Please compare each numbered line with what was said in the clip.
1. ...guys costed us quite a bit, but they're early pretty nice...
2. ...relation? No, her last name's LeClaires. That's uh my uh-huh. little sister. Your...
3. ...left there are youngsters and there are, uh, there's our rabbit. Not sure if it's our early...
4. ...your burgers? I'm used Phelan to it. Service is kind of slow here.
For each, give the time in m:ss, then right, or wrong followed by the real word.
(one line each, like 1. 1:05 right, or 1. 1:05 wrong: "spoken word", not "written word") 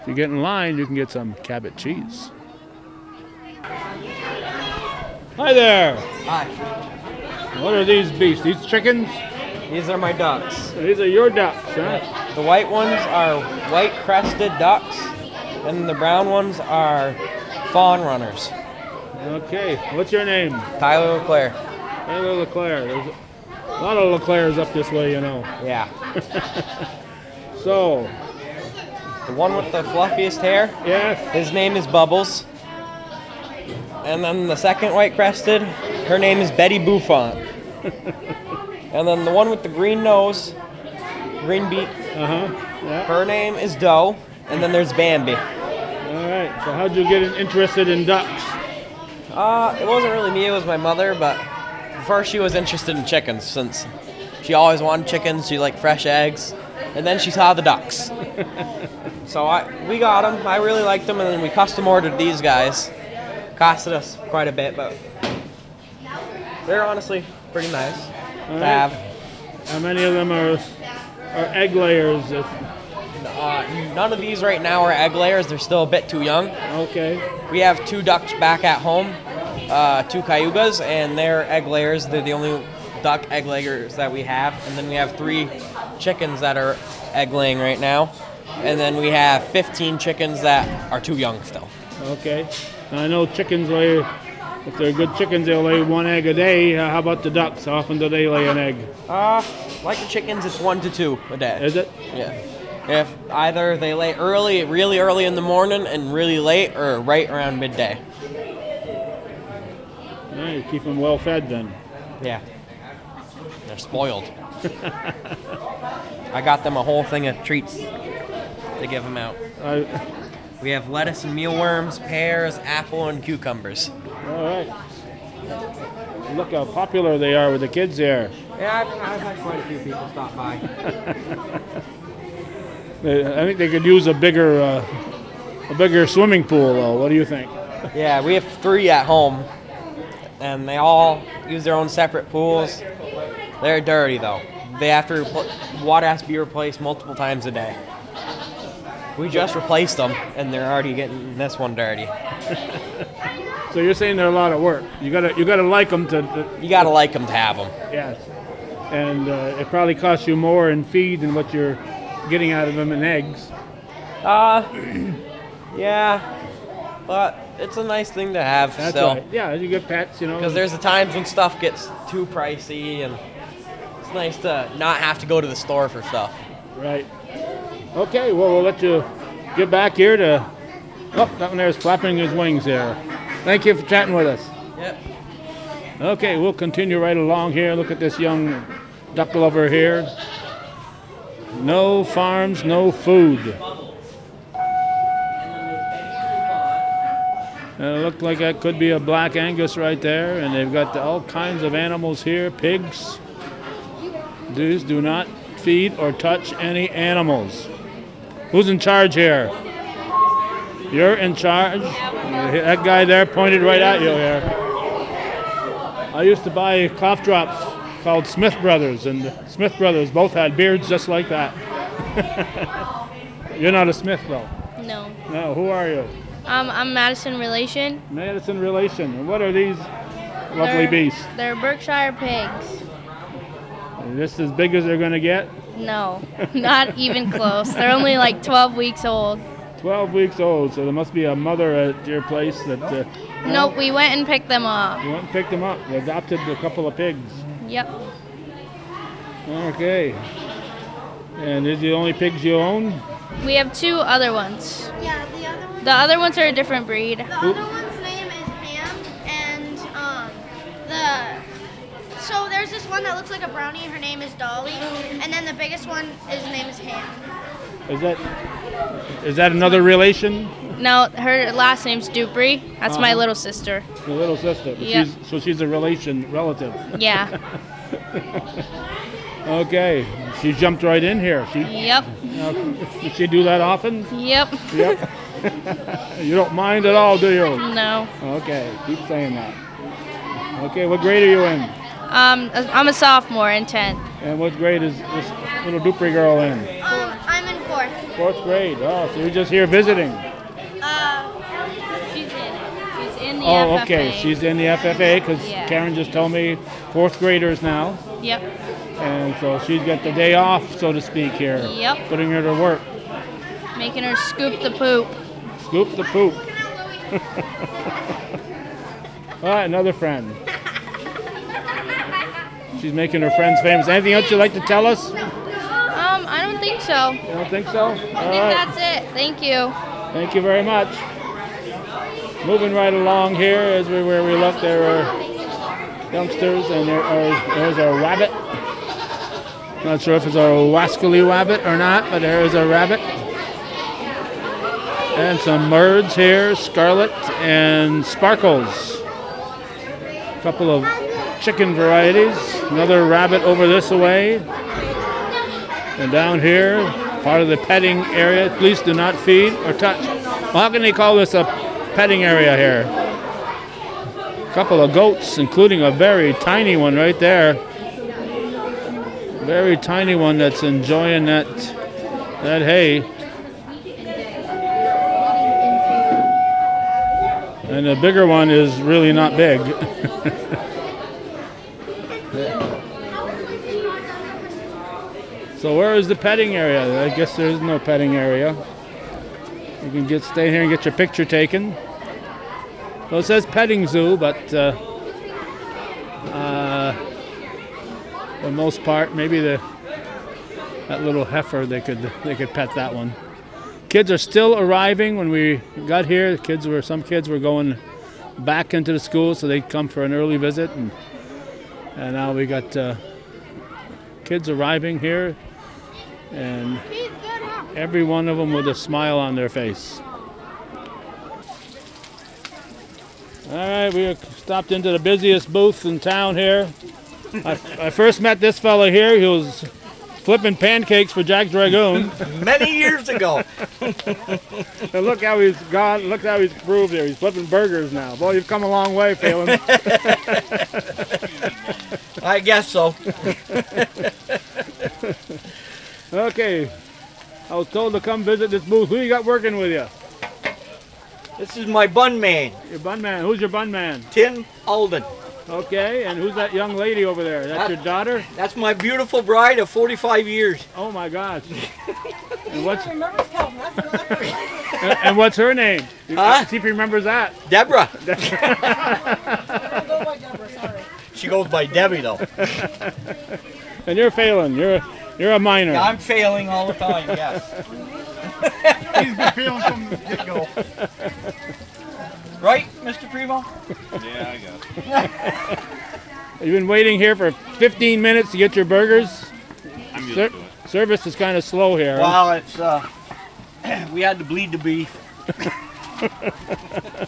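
1. 1:02 wrong: "honestly", not "early"
2. 4:29 wrong: "Dupree", not "LeClaires"
3. 5:34 wrong: "wascally", not "early"
4. 8:08 wrong: "Ser", not "Phelan".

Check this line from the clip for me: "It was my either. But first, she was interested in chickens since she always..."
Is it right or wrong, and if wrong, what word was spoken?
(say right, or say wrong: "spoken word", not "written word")
wrong: "mother", not "either".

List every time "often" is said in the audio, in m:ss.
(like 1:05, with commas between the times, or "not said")
1:37, 4:43.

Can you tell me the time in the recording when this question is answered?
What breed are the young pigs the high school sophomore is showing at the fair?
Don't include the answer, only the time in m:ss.
3:51.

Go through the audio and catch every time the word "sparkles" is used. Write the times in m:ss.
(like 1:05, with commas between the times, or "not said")
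5:48.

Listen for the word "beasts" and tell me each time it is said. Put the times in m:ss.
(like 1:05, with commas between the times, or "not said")
0:08, 3:50.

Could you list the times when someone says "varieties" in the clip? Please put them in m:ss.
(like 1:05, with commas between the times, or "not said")
5:51.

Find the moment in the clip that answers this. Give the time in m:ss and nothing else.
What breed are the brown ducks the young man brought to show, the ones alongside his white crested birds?
0:17.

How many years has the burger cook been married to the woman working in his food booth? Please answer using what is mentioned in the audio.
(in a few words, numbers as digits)
45.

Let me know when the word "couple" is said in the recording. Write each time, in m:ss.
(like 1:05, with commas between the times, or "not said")
4:06, 5:50, 6:04.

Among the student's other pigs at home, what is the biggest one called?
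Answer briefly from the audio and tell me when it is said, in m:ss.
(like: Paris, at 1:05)
Ham, at 4:26.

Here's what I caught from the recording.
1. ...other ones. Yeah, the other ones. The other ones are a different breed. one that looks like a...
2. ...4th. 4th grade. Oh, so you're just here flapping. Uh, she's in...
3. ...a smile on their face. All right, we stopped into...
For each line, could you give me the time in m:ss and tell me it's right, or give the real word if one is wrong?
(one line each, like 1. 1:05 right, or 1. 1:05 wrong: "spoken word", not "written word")
1. 4:13 right
2. 4:57 wrong: "visiting", not "flapping"
3. 6:58 right.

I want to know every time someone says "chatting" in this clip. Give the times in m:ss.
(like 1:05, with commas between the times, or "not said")
3:03.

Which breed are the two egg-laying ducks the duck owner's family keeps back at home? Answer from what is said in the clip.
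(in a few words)
Cayugas.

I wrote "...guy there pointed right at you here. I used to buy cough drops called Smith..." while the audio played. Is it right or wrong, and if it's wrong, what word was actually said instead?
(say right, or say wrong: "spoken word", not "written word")
right.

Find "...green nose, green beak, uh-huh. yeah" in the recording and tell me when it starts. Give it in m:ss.
0:39.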